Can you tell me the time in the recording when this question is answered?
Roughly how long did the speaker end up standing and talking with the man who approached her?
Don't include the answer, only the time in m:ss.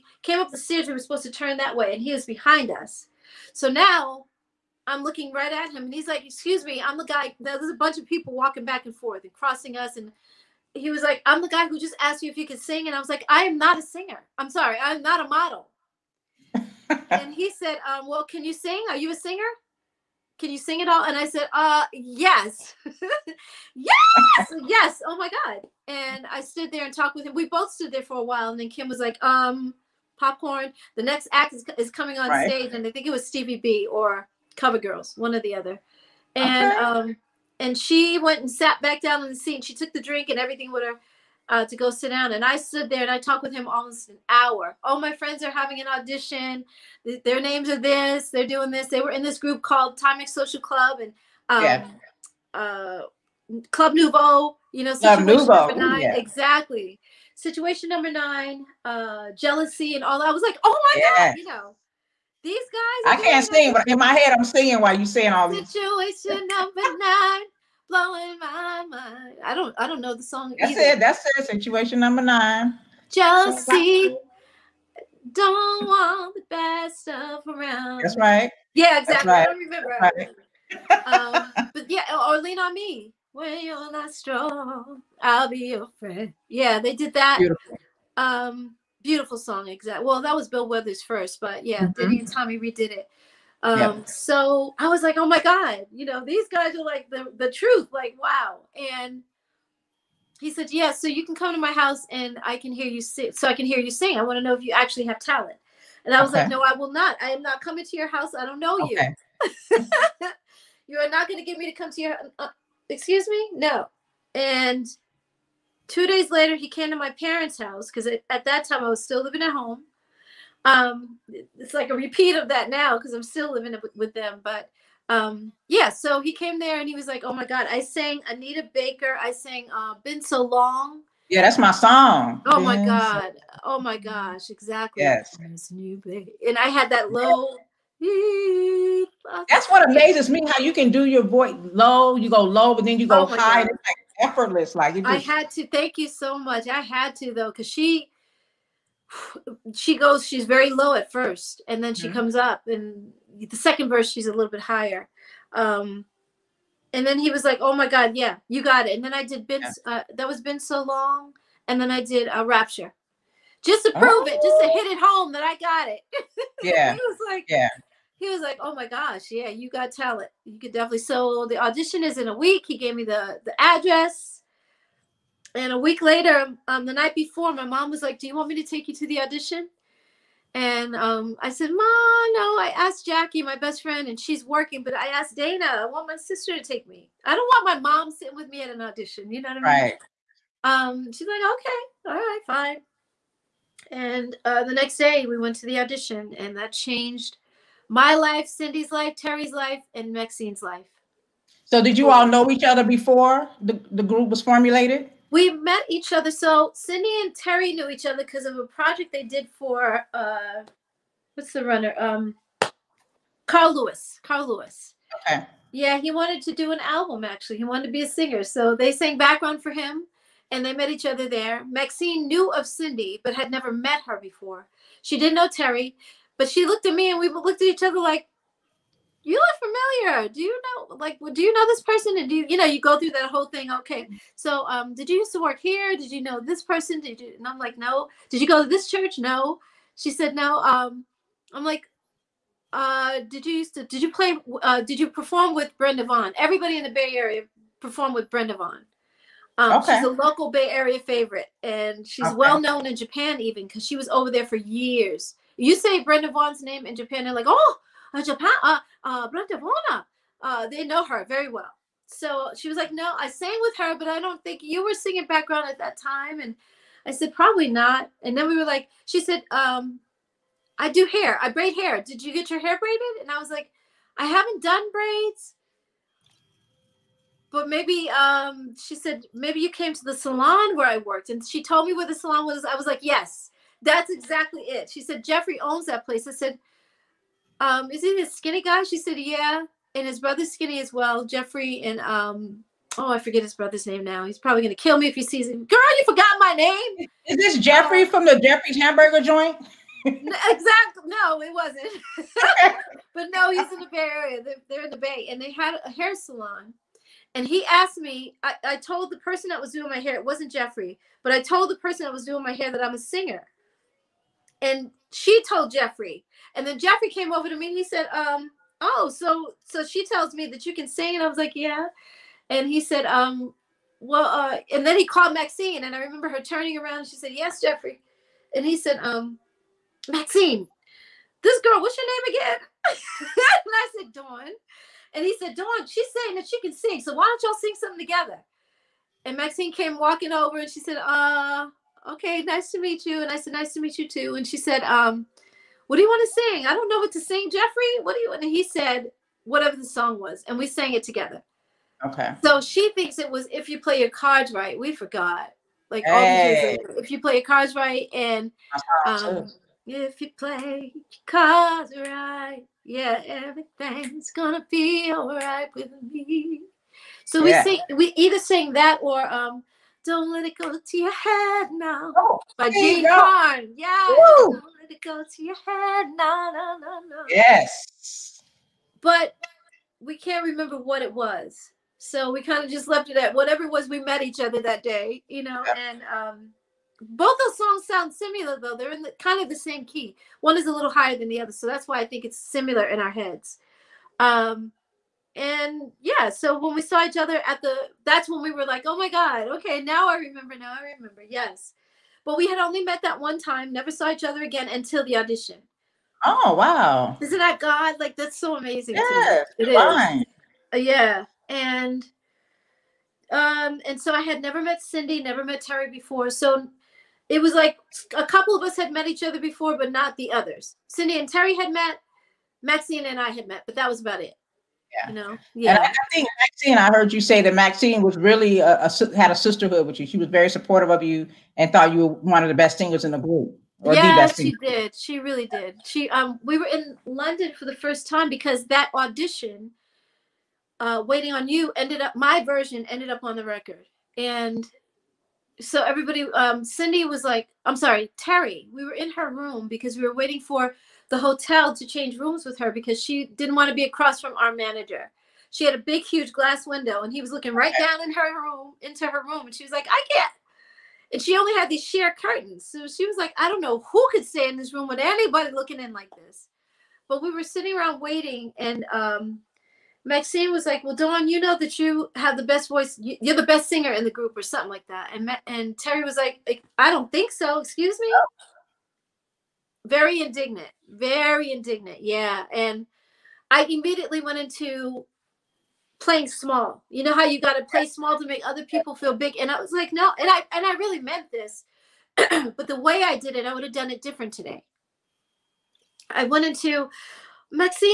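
0:43.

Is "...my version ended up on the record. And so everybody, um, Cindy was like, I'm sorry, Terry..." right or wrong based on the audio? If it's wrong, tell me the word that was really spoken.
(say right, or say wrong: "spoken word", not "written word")
right.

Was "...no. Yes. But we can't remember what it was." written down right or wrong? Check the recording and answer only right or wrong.
right.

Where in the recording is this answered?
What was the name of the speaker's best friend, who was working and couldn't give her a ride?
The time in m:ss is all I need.
3:03.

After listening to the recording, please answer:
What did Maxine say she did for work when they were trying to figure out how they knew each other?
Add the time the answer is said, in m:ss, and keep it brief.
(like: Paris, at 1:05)
braid hair, at 4:31.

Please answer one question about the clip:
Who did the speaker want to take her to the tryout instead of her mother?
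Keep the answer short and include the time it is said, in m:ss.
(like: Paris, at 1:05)
Dana, at 3:05.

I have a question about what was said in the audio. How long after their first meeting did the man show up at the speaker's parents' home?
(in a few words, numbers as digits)
two days.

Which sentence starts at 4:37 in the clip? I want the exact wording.
But maybe um, she said, maybe you came to the salon where I worked.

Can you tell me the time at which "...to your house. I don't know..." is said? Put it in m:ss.
1:47.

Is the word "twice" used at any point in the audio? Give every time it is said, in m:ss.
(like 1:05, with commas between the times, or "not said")
not said.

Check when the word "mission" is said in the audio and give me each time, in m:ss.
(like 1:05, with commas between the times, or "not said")
not said.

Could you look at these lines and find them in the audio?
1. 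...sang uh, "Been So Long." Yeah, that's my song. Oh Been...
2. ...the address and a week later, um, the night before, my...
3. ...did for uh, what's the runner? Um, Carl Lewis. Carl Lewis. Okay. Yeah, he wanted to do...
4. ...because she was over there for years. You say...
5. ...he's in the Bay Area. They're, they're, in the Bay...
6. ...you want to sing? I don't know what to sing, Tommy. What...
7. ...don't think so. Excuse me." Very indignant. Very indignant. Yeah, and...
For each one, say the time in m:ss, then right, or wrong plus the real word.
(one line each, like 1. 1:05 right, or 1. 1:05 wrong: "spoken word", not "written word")
1. 2:09 right
2. 2:53 right
3. 3:29 right
4. 4:13 right
5. 5:03 right
6. 5:46 wrong: "Jeffrey", not "Tommy"
7. 7:56 right.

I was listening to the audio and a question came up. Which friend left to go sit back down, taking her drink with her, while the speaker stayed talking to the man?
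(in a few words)
Kim.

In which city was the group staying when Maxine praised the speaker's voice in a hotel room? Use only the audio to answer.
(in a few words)
London.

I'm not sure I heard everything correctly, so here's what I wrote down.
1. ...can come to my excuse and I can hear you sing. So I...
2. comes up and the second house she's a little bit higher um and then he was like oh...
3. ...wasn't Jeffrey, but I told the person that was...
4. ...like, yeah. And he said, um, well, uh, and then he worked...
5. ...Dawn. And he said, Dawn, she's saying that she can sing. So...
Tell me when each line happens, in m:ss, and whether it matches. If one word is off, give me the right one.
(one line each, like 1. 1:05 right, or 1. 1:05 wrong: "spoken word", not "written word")
1. 1:41 wrong: "house", not "excuse"
2. 2:32 wrong: "verse", not "house"
3. 5:10 right
4. 5:21 wrong: "called", not "worked"
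5. 5:34 right.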